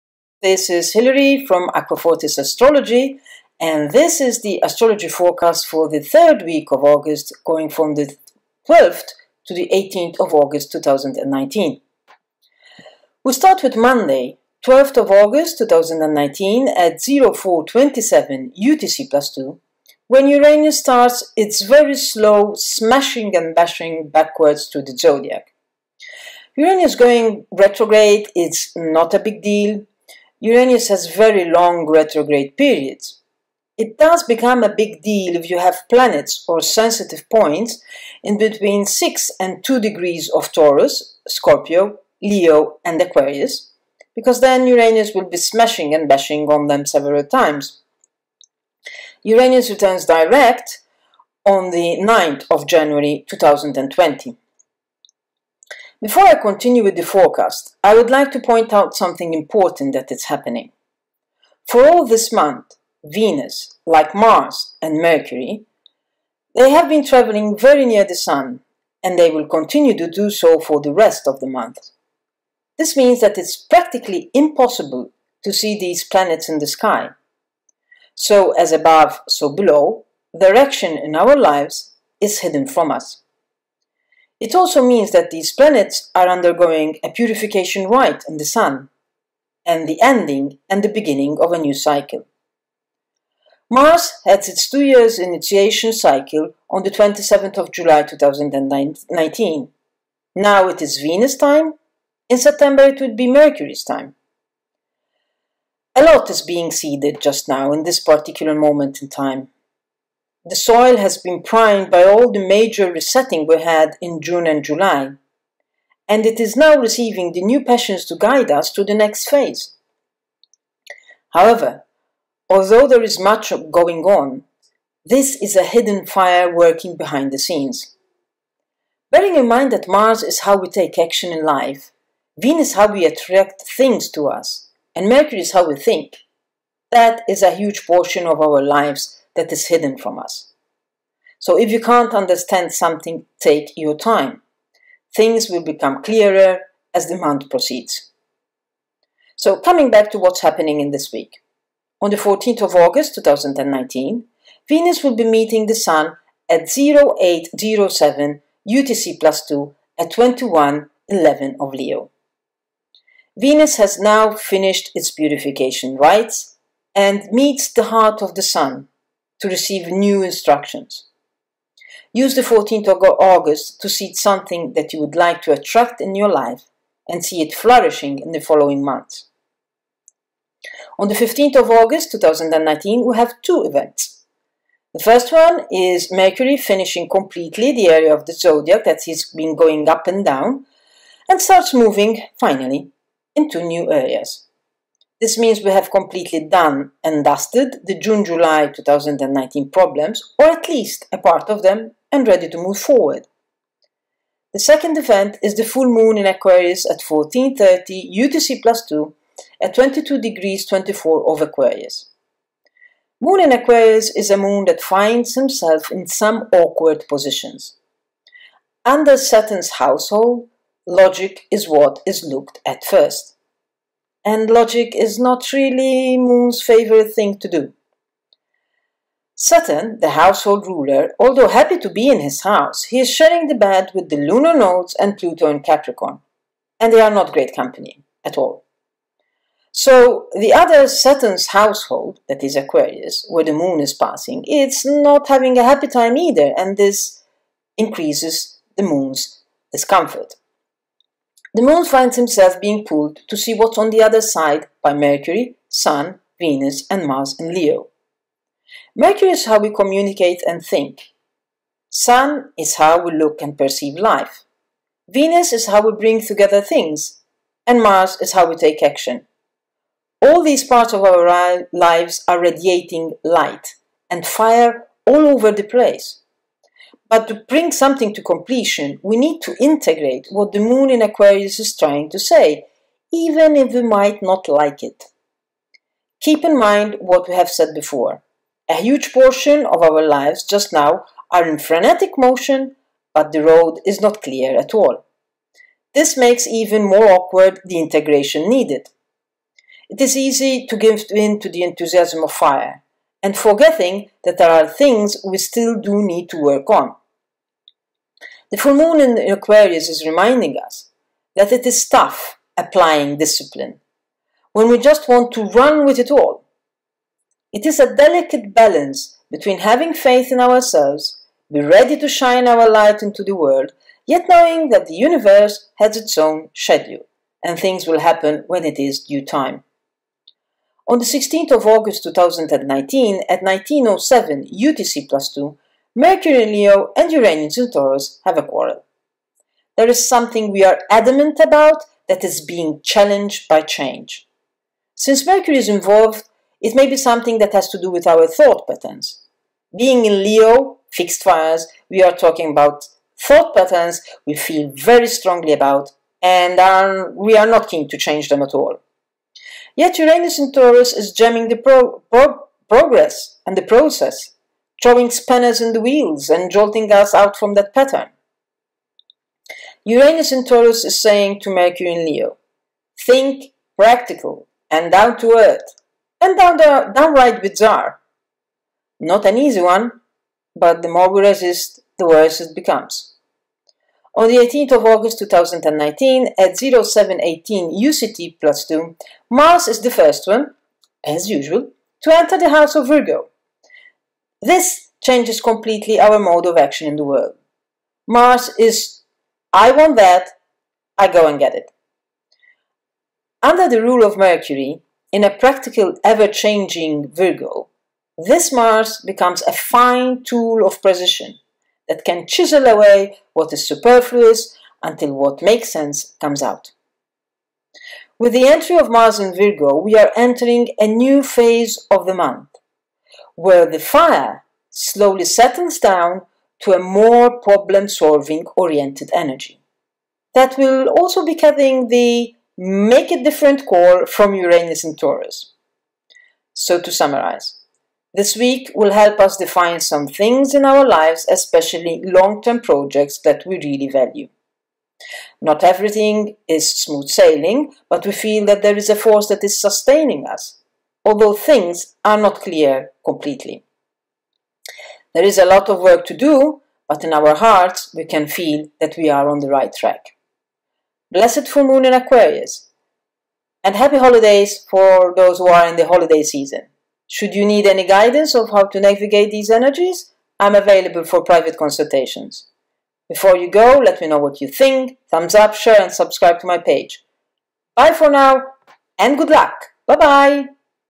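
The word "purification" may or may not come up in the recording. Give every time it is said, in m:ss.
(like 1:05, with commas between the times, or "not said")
1:27, 2:45.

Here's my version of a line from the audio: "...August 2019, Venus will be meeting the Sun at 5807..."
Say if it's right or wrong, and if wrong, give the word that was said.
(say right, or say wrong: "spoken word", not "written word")
wrong: "0807", not "5807".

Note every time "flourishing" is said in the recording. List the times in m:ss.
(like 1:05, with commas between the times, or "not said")
2:57.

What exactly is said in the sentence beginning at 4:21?
Sun is how we look and perceive life.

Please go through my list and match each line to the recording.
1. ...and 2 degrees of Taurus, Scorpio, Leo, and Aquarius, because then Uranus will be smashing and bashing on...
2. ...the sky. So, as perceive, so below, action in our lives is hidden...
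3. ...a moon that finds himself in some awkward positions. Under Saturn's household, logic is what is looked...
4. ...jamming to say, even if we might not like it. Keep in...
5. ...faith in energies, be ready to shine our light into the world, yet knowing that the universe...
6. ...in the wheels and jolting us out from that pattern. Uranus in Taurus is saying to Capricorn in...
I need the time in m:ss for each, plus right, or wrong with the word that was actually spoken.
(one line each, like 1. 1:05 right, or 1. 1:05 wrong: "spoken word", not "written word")
1. 0:39 right
2. 1:16 wrong: "above", not "perceive"
3. 3:34 right
4. 4:41 wrong: "trying", not "jamming"
5. 5:19 wrong: "ourselves", not "energies"
6. 6:05 wrong: "Mercury", not "Capricorn".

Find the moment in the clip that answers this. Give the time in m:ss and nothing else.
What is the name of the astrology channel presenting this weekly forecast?
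0:01.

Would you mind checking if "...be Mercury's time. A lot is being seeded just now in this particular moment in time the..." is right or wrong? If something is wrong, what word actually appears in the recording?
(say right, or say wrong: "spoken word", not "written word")
right.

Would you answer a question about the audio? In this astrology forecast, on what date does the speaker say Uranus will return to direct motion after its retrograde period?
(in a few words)
9 January 2020.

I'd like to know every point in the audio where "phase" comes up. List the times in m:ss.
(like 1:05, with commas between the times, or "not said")
1:59, 7:01.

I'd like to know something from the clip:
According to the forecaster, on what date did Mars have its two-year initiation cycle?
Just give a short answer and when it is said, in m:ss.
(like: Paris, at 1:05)
27 July 2019, at 1:36.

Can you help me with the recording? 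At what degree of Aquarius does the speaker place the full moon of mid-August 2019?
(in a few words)
22°24'.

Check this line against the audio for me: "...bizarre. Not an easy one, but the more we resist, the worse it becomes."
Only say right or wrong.
right.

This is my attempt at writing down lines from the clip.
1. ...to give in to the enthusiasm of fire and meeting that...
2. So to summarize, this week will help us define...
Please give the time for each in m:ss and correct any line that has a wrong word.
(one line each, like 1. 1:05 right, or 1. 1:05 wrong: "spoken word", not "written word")
1. 5:00 wrong: "forgetting", not "meeting"
2. 7:16 right.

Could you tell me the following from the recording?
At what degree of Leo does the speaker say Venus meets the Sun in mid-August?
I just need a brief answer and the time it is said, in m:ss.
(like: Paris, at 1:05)
21°11' Leo, at 2:40.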